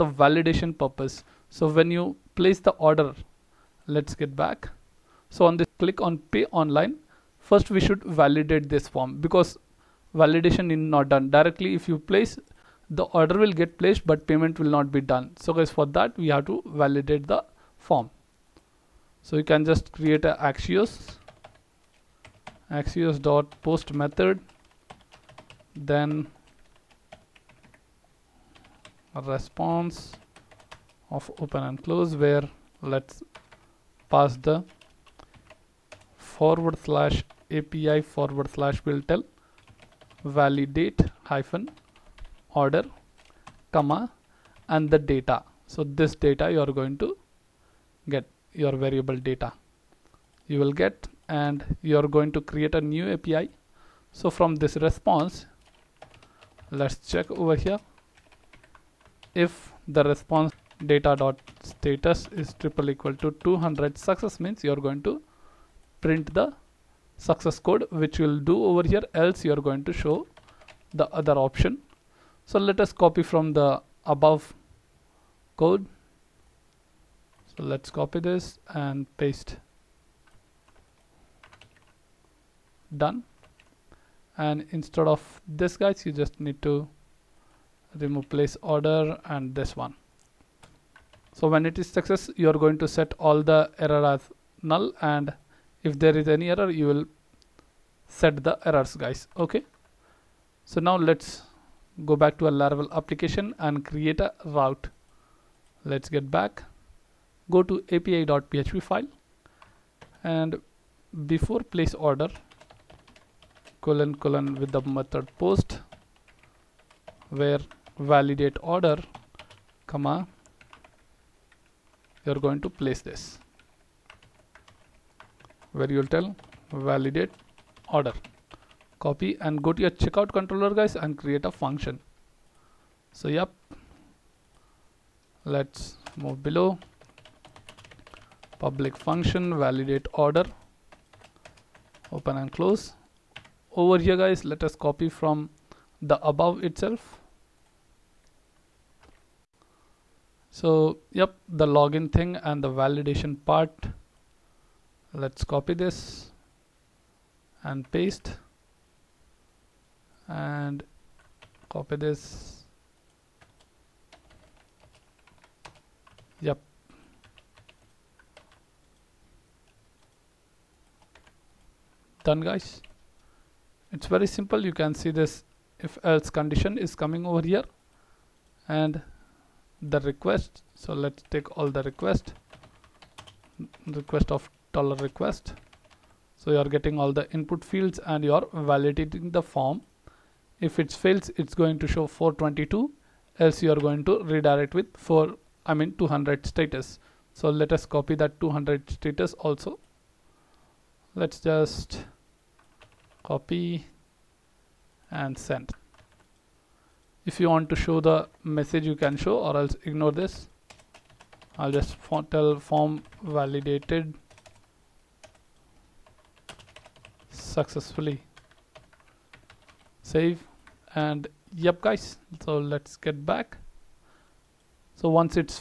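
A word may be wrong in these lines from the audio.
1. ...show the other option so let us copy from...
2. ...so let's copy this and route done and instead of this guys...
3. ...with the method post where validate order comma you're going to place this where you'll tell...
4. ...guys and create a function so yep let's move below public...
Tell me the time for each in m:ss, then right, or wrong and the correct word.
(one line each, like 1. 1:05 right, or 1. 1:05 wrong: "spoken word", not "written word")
1. 1:09 right
2. 1:17 wrong: "paste", not "route"
3. 1:54 right
4. 2:10 right.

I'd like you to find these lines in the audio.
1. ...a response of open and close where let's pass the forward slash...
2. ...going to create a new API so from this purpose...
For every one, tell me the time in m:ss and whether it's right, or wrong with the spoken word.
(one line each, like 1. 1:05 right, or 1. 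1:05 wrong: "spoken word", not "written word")
1. 0:29 right
2. 0:52 wrong: "response", not "purpose".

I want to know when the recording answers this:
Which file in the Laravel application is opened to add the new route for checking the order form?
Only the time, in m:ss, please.
1:47.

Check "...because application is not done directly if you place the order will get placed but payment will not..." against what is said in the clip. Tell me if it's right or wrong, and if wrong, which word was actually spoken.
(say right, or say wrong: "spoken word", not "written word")
wrong: "validation", not "application".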